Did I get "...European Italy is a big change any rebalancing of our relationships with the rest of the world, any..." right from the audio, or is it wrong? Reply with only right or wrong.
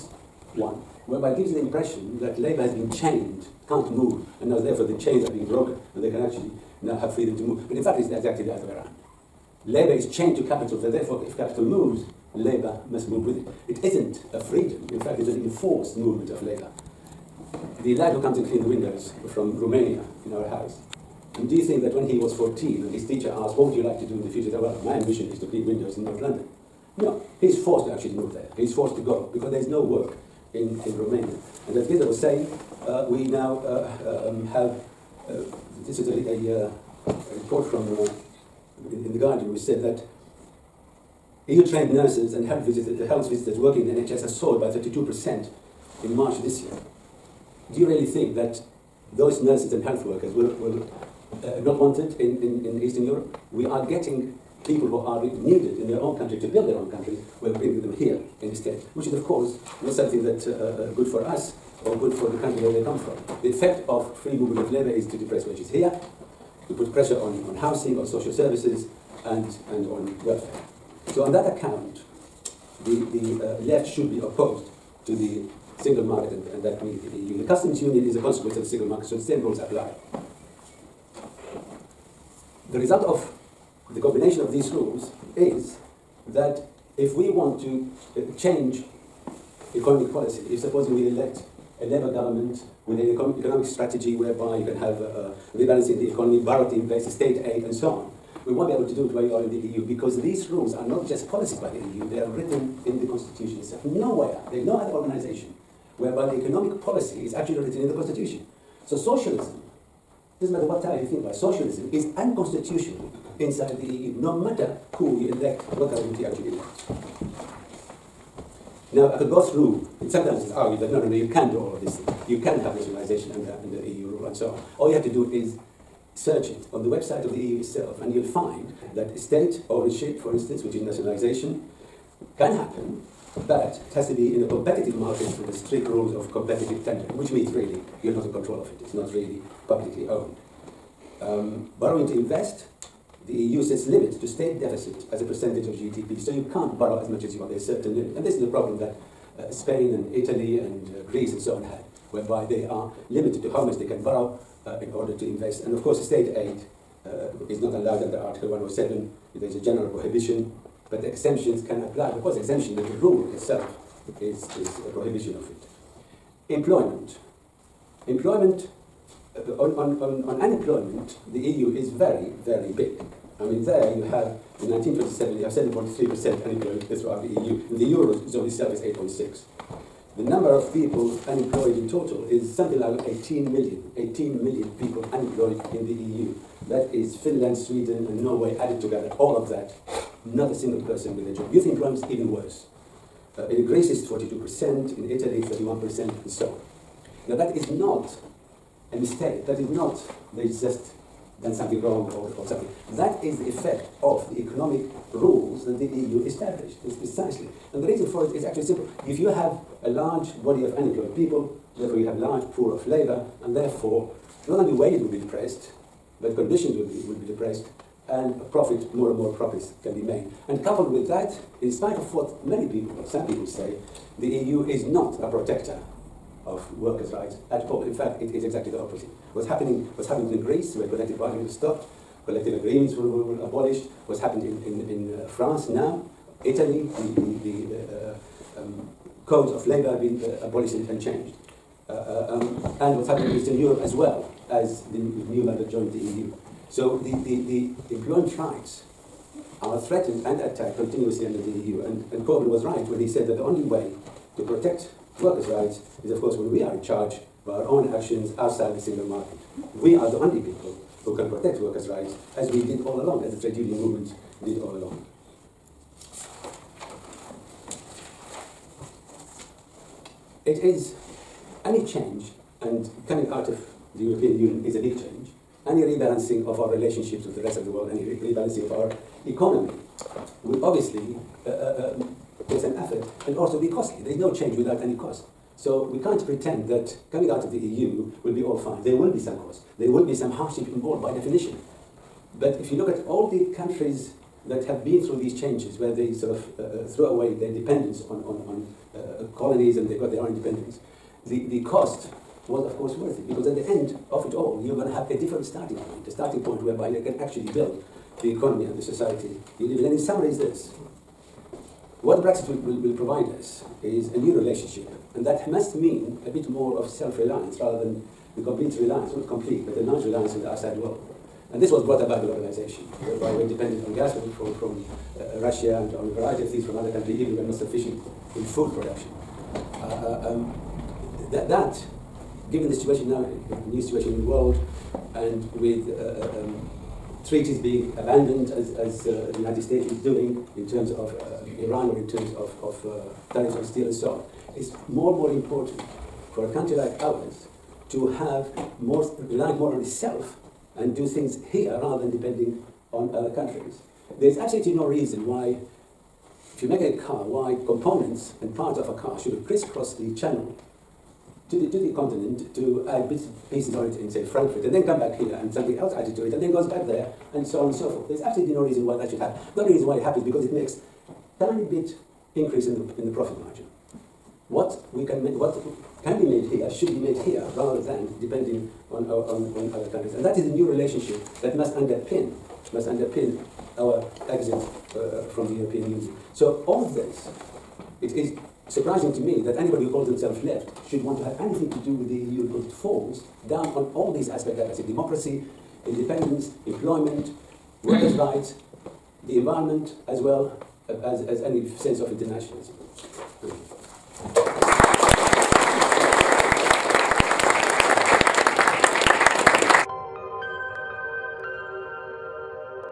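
wrong.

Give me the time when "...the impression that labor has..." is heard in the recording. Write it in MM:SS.
00:01.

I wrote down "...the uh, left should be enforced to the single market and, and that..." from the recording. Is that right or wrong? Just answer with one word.
wrong.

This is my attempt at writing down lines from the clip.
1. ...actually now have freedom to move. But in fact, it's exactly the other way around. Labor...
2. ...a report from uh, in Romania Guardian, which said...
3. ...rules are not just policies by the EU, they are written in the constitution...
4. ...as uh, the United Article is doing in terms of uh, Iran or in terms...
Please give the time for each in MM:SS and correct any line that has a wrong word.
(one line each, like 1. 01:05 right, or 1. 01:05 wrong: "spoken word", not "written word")
1. 00:06 right
2. 00:37 wrong: "The", not "Romania"
3. 01:40 right
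4. 05:38 wrong: "States", not "Article".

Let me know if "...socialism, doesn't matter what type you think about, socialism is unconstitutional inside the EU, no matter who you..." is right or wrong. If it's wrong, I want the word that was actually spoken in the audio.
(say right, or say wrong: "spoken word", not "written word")
right.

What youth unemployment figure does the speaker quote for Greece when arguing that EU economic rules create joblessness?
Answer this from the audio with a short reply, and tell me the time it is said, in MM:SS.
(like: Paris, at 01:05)
42%, at 03:14.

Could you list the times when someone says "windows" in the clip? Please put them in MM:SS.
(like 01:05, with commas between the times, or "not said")
00:18, 00:25.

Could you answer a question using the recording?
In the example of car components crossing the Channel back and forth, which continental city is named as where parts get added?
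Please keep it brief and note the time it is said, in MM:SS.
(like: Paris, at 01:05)
Frankfurt, at 06:04.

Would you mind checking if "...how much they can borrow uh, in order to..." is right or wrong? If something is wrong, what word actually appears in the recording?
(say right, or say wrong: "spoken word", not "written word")
right.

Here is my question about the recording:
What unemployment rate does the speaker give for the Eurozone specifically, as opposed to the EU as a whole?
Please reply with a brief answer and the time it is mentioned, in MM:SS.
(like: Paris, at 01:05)
8.6%, at 02:58.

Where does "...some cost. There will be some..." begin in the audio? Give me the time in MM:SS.
04:49.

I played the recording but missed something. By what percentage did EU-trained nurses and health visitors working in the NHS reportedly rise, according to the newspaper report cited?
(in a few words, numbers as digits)
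32%.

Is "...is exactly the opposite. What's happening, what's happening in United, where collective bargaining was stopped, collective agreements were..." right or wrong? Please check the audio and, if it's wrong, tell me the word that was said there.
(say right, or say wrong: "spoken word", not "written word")
wrong: "Greece", not "United".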